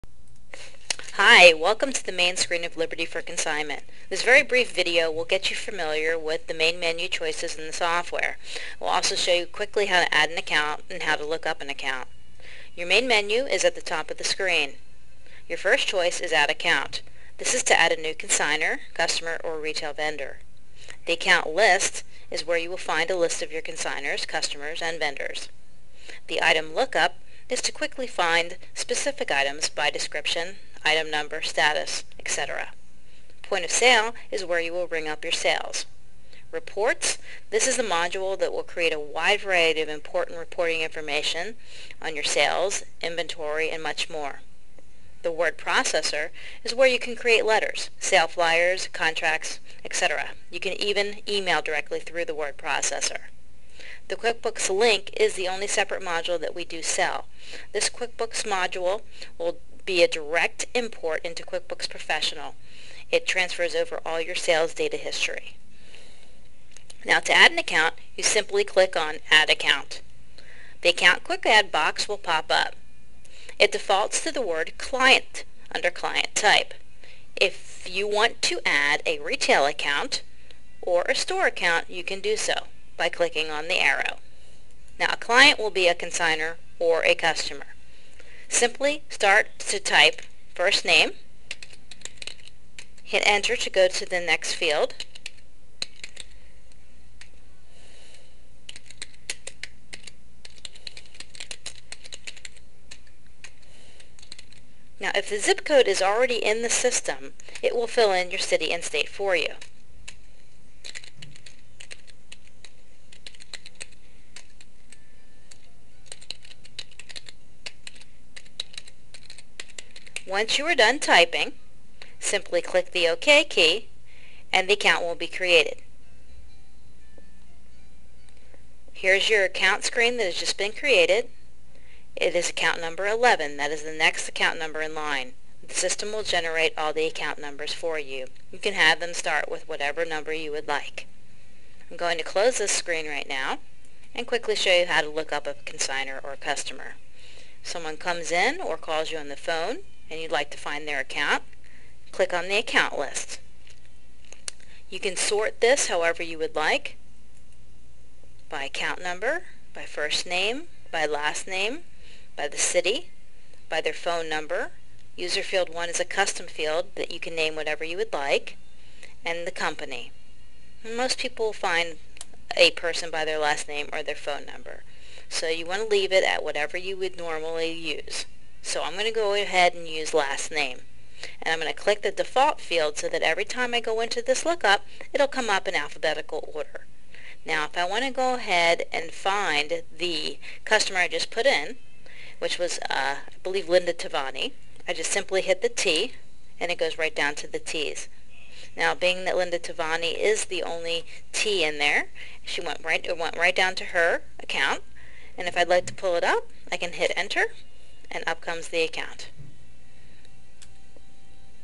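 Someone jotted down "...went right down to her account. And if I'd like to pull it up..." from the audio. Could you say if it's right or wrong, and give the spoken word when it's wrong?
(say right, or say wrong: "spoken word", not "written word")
right.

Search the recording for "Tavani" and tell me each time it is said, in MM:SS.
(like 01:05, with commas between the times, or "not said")
03:13, 03:19.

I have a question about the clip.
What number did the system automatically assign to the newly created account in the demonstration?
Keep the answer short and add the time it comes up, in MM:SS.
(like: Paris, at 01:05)
11, at 02:13.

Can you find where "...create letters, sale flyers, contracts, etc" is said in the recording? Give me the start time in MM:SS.
00:47.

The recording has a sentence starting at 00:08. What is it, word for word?
We'll also show you quickly how to add an account and how to look up an account.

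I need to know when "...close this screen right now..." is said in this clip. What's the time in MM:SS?
02:22.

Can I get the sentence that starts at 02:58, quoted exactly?
So I'm going to go ahead and use last name.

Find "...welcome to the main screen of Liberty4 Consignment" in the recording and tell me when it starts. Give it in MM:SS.
00:01.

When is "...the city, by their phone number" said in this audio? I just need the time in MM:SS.
02:42.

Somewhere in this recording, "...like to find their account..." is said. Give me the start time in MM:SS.
02:30.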